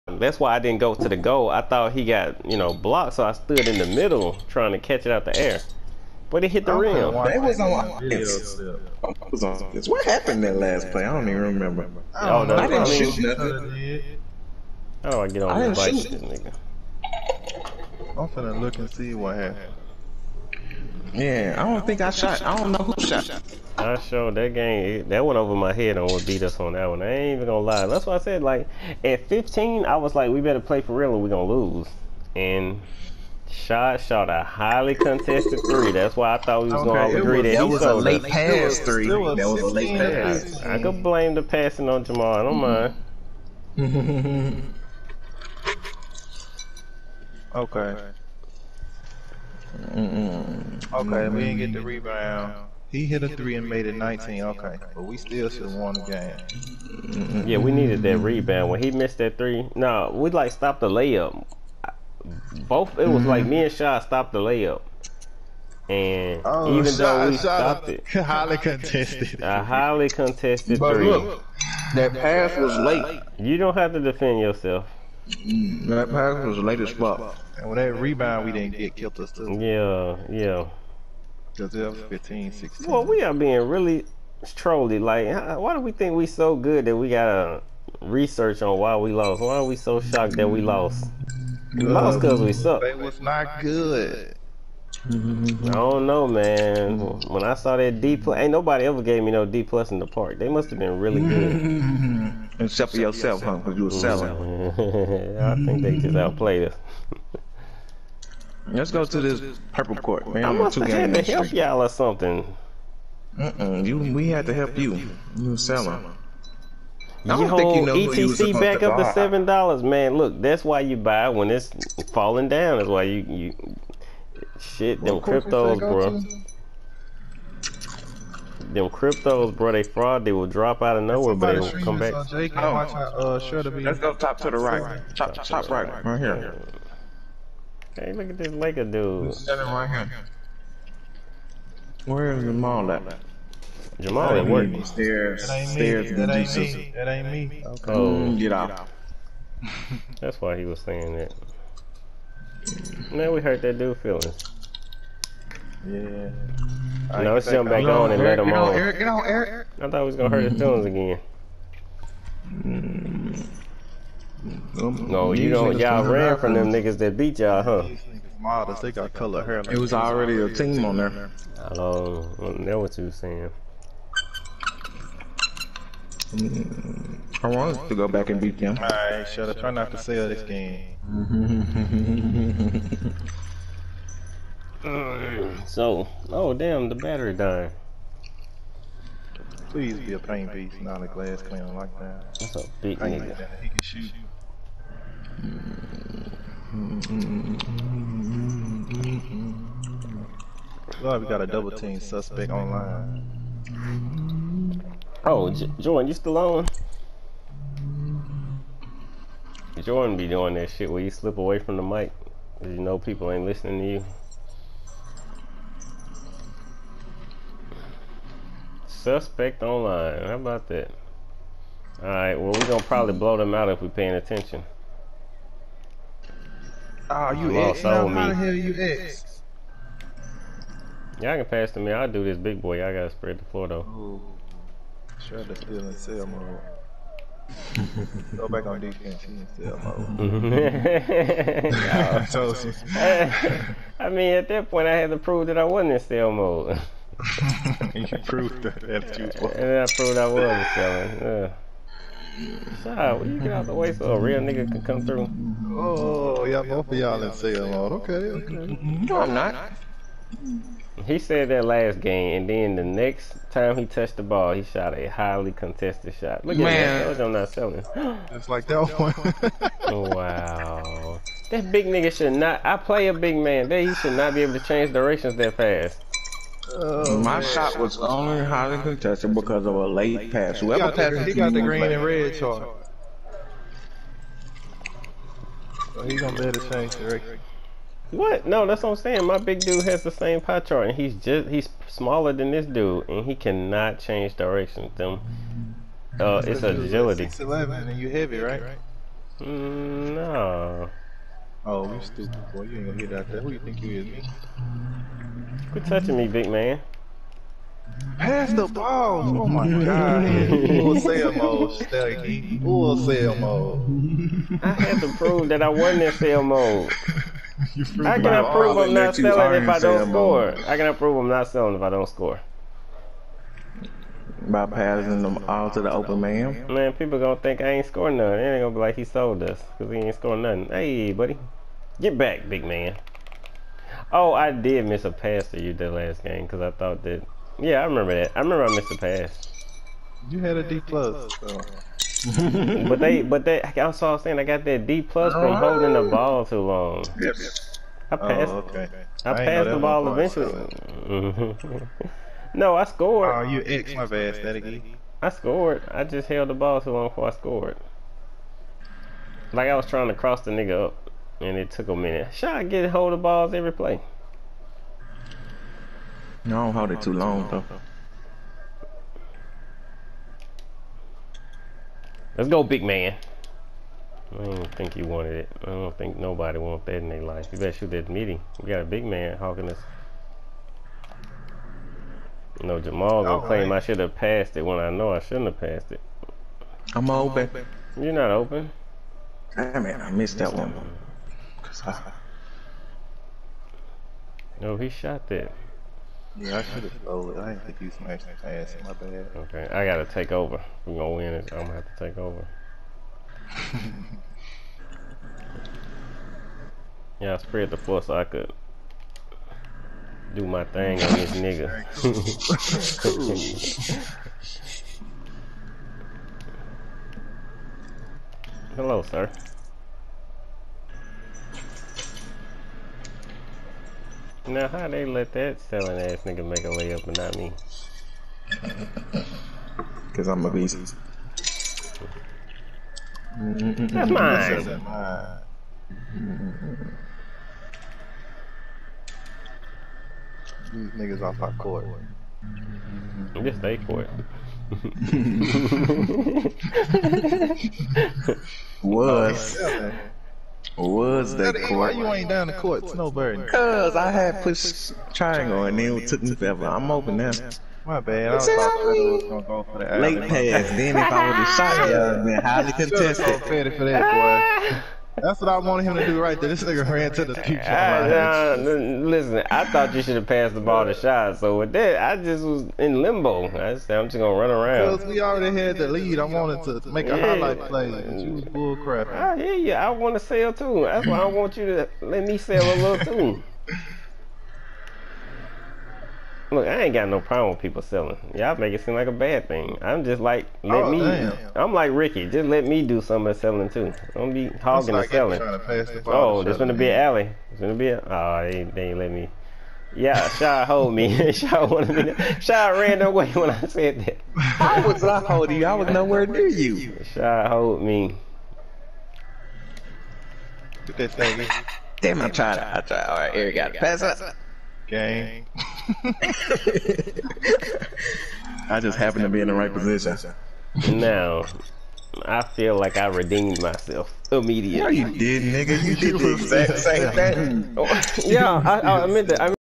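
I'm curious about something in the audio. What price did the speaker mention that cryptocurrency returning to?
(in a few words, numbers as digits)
$7.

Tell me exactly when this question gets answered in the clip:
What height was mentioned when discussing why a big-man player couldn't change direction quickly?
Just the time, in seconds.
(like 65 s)
297 s.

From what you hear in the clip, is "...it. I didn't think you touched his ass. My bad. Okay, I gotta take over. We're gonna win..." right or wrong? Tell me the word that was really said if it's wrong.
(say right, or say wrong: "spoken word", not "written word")
wrong: "smashed", not "touched".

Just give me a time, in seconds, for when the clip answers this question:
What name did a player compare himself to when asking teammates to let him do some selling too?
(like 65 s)
491 s.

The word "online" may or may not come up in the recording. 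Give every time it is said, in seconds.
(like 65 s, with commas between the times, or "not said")
202 s, 219 s.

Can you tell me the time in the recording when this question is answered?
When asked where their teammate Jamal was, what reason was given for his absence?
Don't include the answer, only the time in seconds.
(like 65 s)
143 s.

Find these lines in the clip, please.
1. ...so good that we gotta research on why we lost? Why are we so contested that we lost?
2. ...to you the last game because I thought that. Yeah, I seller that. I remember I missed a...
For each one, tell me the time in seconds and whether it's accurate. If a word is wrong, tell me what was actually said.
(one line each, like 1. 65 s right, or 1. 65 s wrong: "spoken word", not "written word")
1. 86 s wrong: "shocked", not "contested"
2. 335 s wrong: "remember", not "seller".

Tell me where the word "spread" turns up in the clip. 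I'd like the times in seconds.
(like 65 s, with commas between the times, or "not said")
233 s, 407 s.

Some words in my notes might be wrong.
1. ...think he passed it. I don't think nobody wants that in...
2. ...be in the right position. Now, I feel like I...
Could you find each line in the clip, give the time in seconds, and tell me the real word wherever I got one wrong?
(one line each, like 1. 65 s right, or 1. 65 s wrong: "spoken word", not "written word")
1. 374 s wrong: "wanted", not "passed"
2. 519 s right.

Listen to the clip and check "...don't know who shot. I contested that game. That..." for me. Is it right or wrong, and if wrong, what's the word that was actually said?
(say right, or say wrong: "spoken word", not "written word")
wrong: "showed", not "contested".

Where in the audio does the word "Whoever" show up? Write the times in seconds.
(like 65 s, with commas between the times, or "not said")
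280 s.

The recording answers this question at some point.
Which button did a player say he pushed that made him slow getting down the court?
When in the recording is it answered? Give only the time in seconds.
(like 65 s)
455 s.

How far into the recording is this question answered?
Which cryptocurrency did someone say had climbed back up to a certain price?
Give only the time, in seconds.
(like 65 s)
117 s.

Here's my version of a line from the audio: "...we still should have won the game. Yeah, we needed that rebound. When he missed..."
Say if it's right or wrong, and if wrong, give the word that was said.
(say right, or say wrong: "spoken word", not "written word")
right.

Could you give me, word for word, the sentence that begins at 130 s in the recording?
They will drop out of nowhere, but they will come back.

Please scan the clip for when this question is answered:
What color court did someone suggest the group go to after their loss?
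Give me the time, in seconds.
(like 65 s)
109 s.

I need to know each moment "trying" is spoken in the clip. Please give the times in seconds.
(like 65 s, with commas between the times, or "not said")
4 s, 359 s, 512 s.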